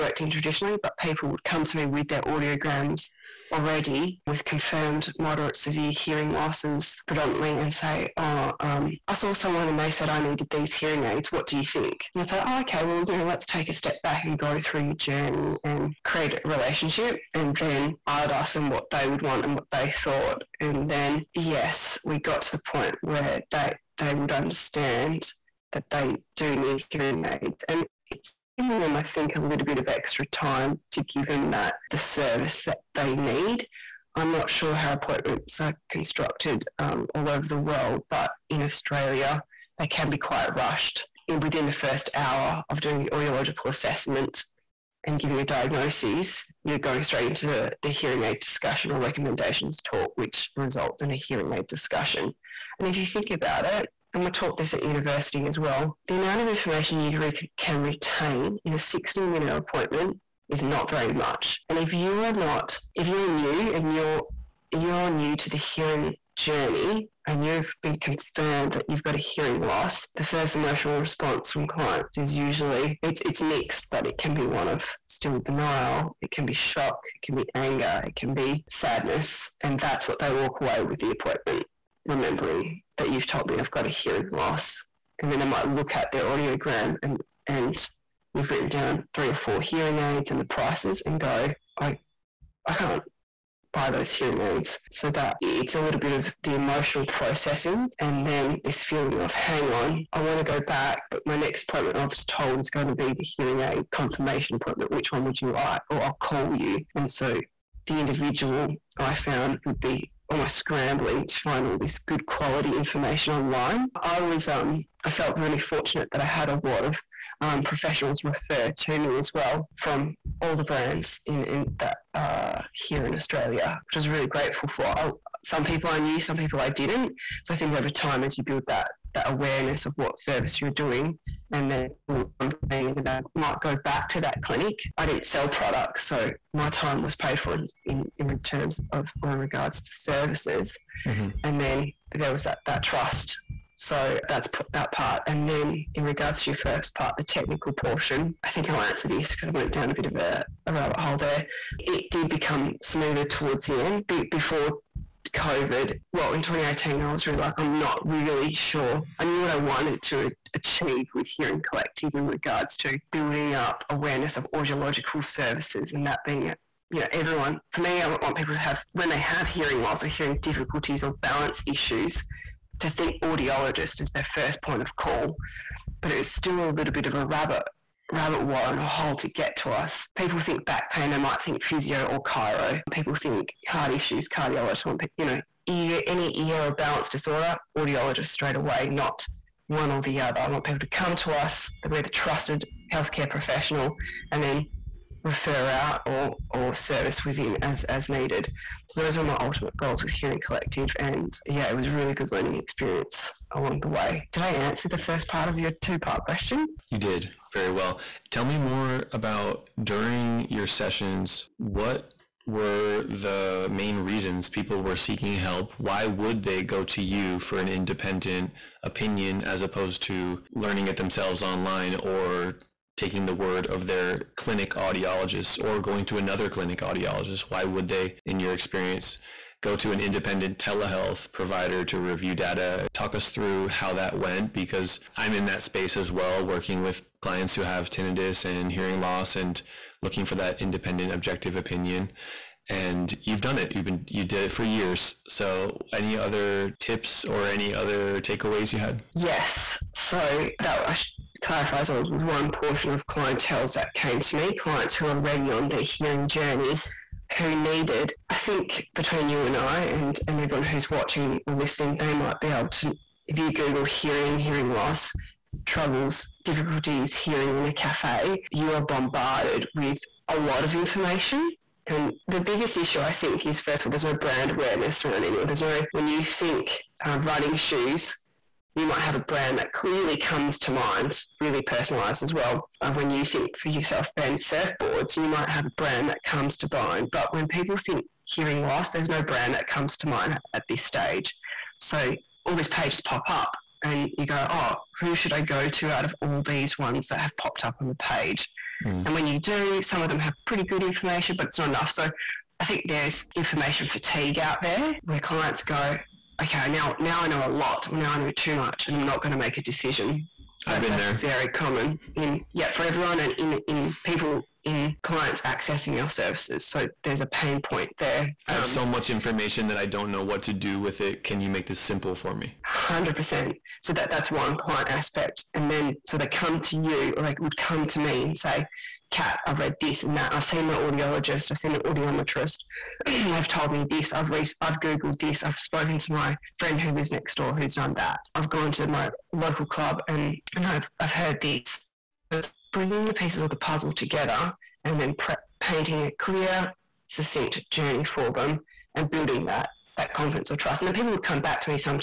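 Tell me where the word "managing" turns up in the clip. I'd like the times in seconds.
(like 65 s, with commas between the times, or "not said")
not said.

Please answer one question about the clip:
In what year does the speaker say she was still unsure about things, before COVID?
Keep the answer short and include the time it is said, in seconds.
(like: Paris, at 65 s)
2018, at 156 s.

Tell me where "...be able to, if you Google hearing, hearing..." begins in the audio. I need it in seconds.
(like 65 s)
262 s.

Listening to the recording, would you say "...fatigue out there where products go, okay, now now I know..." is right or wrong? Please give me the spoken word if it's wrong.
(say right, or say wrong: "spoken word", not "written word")
wrong: "clients", not "products".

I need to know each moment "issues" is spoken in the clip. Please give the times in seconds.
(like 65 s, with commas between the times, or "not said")
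171 s, 183 s, 272 s.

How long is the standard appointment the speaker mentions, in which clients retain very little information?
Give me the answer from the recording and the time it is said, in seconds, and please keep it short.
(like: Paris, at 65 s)
60 minutes, at 58 s.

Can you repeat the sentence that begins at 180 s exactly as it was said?
People think back pain, they might think physio or chiro.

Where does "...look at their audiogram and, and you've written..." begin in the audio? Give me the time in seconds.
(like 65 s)
85 s.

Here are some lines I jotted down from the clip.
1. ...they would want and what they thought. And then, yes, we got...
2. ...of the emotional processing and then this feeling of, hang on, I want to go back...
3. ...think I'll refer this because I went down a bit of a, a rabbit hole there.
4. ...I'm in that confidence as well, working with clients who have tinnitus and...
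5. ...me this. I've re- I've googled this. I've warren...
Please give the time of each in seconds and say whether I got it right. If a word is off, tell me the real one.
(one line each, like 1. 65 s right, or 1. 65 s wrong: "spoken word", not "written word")
1. 18 s right
2. 96 s right
3. 148 s wrong: "answer", not "refer"
4. 235 s wrong: "space", not "confidence"
5. 333 s wrong: "spoken", not "warren".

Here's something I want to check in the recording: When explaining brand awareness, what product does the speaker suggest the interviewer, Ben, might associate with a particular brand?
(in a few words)
surfboards.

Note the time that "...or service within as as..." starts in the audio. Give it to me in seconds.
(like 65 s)
196 s.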